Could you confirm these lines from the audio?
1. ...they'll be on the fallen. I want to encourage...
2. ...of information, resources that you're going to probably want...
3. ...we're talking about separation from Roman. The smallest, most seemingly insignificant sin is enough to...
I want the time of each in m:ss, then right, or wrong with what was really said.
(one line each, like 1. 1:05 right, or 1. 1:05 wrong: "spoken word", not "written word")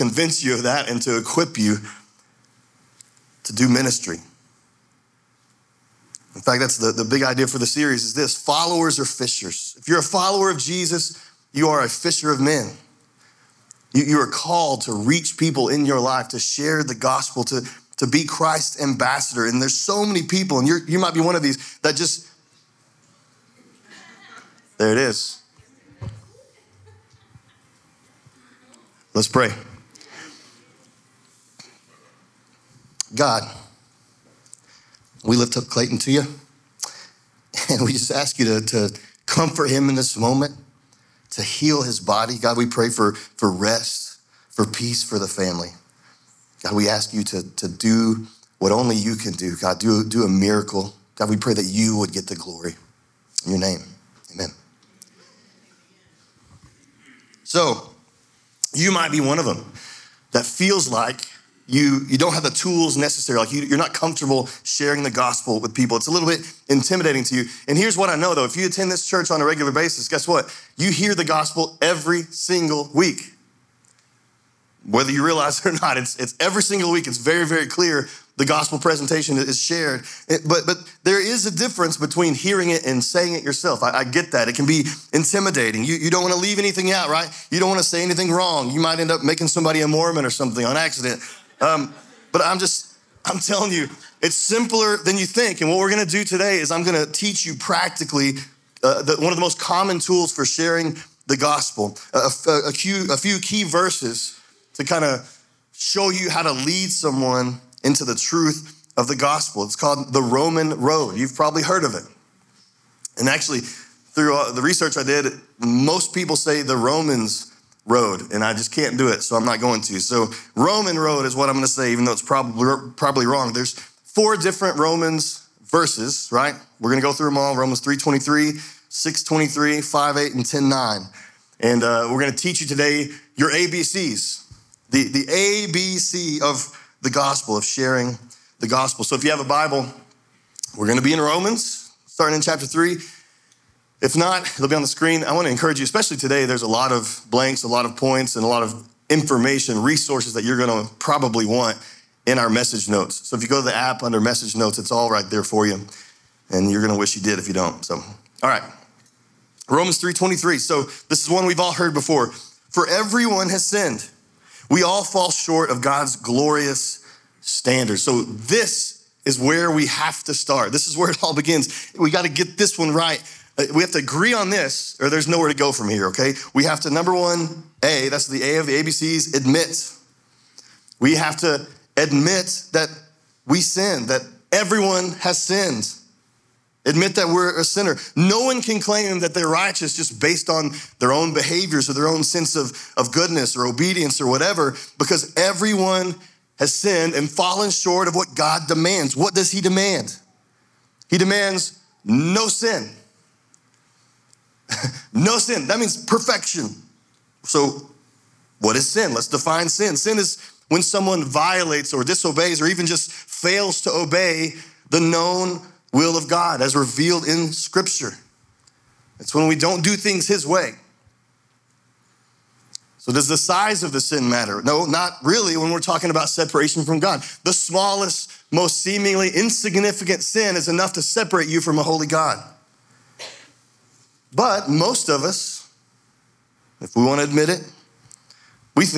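1. 2:24 wrong: "screen", not "fallen"
2. 2:28 right
3. 3:45 wrong: "God", not "Roman".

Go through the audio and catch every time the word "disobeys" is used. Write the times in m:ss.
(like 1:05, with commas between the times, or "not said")
3:32.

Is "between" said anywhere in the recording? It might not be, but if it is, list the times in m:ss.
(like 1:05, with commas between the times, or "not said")
1:21.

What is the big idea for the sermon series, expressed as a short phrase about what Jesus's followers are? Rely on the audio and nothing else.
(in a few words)
followers are fishers.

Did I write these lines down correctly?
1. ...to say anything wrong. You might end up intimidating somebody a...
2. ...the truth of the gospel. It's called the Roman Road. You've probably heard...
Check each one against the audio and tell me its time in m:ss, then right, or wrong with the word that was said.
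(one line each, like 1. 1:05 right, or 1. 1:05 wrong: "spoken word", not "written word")
1. 1:27 wrong: "making", not "intimidating"
2. 1:48 right.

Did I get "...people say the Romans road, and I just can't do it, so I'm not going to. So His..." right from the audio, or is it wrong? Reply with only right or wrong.
wrong.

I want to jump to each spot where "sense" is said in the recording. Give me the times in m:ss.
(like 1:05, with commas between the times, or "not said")
3:12.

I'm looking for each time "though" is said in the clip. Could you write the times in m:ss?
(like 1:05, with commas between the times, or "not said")
1:08, 2:02.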